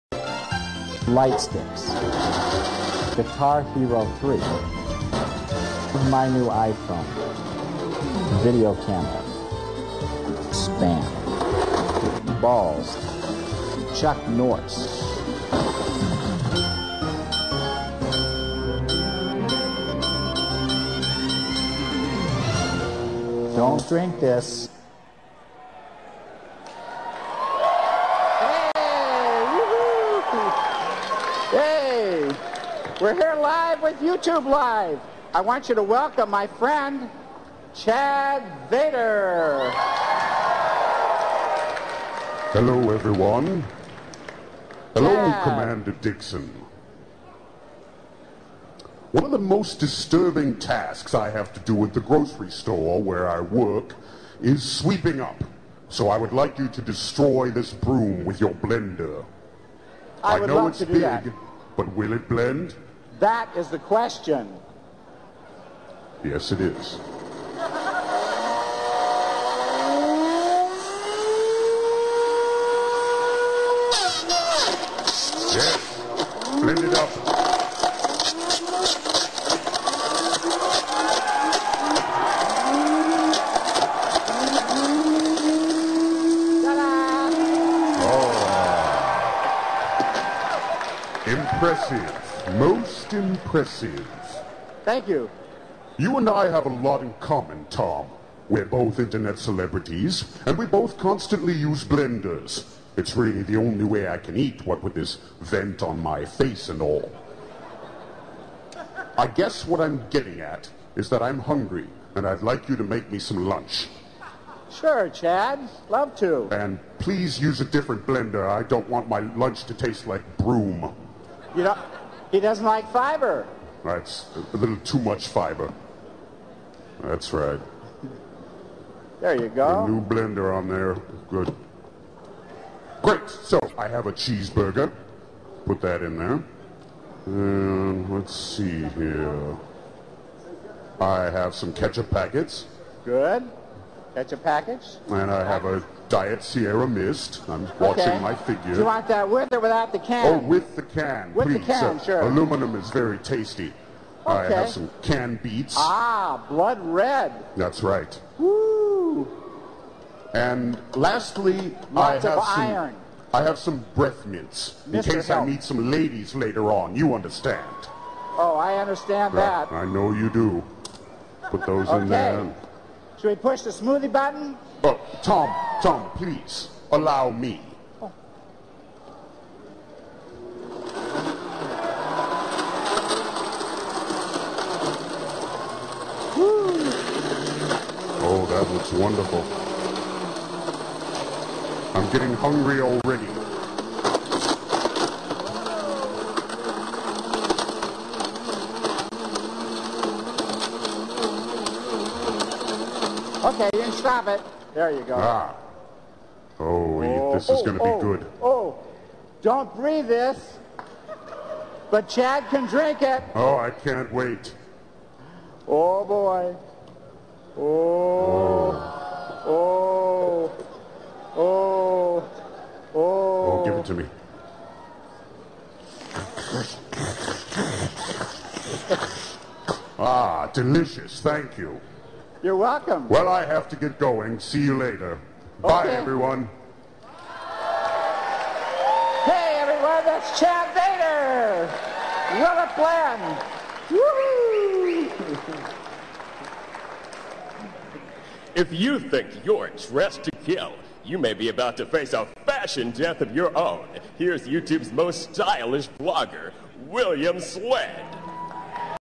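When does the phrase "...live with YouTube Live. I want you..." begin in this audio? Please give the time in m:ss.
0:33.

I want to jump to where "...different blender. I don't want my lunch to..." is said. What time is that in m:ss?
1:57.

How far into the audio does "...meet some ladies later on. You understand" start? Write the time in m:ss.
2:45.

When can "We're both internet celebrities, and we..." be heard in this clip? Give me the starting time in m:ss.
1:38.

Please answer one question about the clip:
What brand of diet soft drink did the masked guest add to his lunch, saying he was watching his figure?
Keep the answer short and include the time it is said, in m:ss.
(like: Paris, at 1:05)
Diet Sierra Mist, at 2:26.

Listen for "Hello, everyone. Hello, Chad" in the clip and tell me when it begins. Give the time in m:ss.
0:42.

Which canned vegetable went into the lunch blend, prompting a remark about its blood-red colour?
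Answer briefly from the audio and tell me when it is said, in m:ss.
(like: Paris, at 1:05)
Beets, at 2:35.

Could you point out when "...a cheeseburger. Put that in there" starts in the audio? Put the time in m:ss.
2:14.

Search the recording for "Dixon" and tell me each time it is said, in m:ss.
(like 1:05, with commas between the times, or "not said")
0:45.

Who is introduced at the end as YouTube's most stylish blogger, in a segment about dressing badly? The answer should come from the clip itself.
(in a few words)
William Sledd.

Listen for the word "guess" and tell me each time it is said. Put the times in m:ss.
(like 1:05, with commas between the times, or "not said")
1:49.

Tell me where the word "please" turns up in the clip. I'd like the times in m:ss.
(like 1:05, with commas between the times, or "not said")
1:56, 2:31, 2:56.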